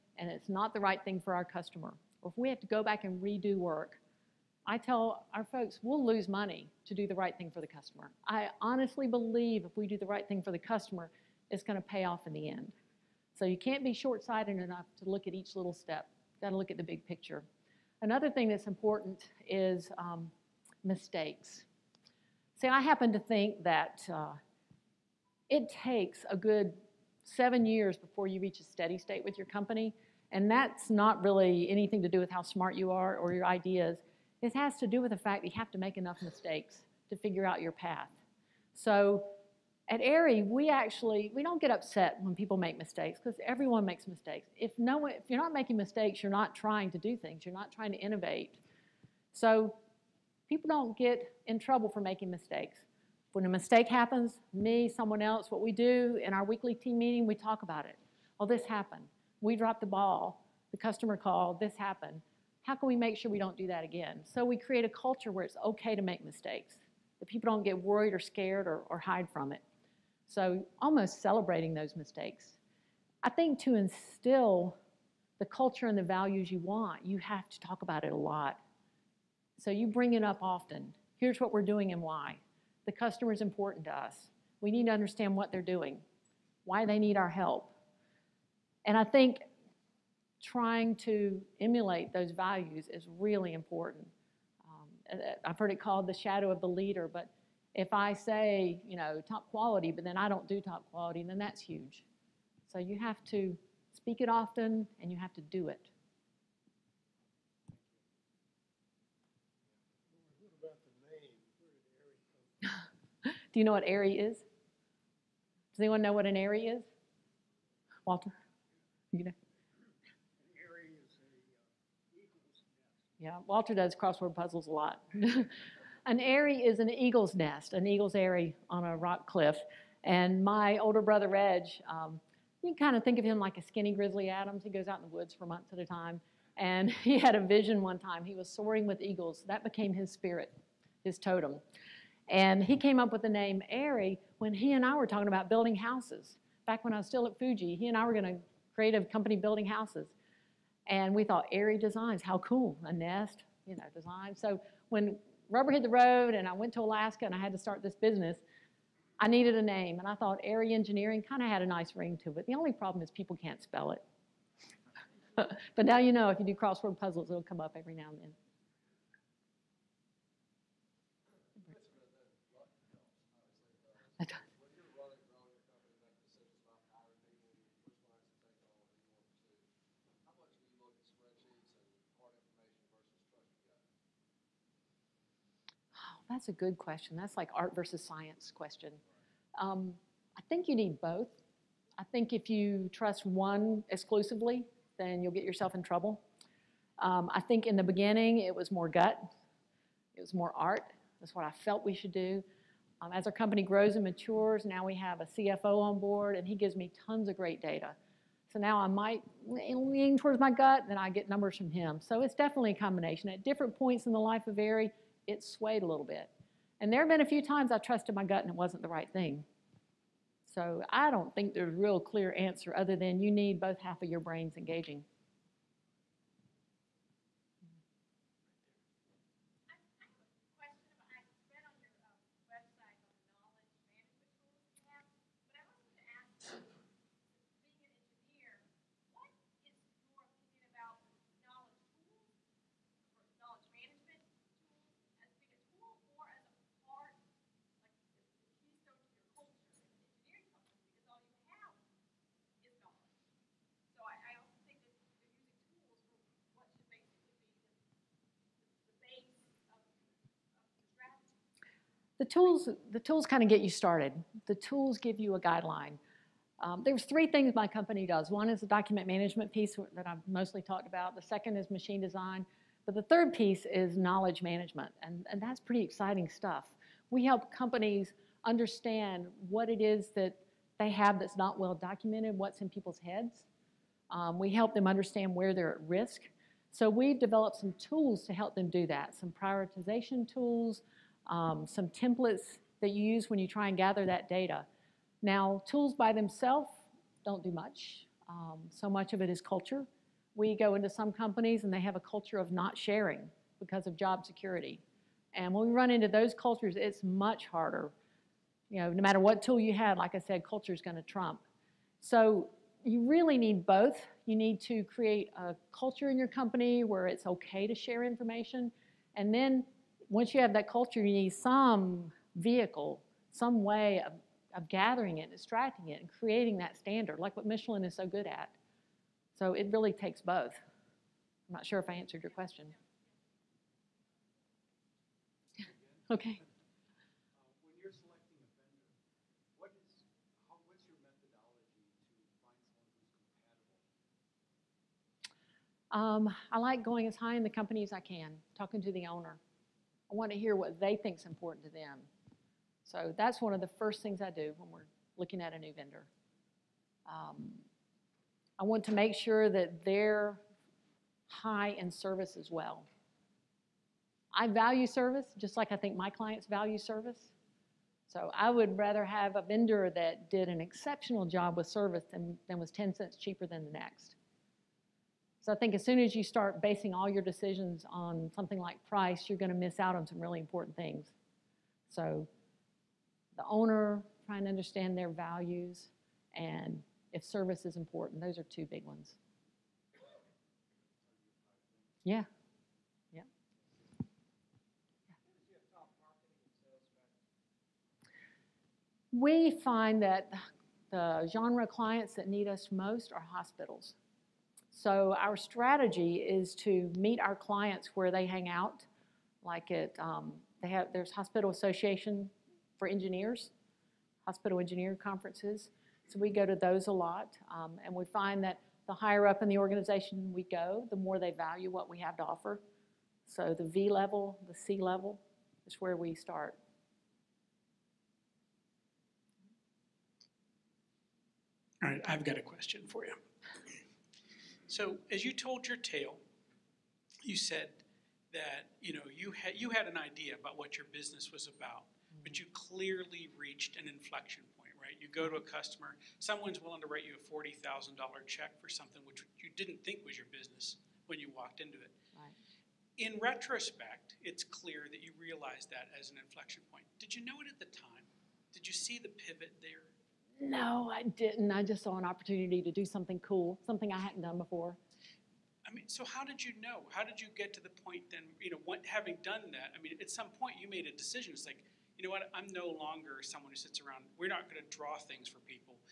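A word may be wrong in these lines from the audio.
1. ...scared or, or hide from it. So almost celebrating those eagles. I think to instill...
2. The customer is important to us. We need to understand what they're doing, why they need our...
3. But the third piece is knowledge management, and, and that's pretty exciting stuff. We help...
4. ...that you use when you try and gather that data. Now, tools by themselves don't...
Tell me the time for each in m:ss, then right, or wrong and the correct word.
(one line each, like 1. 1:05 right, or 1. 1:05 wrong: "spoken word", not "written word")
1. 1:08 wrong: "mistakes", not "eagles"
2. 1:22 right
3. 4:32 right
4. 4:52 right.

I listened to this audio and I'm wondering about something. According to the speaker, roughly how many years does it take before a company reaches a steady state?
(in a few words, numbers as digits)
7.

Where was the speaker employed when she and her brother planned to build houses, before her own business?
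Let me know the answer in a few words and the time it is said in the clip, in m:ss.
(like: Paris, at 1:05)
Fuji, at 2:27.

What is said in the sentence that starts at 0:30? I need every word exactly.
And that's not really anything to do with how smart you are or your ideas.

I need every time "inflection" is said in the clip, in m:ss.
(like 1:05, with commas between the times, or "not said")
7:23, 7:36.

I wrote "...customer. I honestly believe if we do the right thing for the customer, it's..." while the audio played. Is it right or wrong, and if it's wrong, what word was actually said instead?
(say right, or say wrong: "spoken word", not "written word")
right.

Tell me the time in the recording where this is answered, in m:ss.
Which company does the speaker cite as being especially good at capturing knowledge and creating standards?
5:27.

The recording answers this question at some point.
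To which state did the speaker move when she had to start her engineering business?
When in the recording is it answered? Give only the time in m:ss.
2:36.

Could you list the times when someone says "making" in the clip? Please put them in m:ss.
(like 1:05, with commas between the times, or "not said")
0:45, 0:52.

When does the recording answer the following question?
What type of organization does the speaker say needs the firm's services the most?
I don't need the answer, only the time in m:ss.
6:43.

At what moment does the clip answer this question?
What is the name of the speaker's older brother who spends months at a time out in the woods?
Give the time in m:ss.
2:11.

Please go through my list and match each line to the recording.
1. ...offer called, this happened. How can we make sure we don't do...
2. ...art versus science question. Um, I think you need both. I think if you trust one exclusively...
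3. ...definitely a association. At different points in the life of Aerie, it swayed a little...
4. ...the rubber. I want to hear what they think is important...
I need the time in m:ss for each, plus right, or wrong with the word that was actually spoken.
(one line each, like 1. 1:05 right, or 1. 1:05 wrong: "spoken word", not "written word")
1. 1:00 wrong: "customer", not "offer"
2. 3:07 right
3. 3:32 wrong: "combination", not "association"
4. 5:48 wrong: "owner", not "rubber".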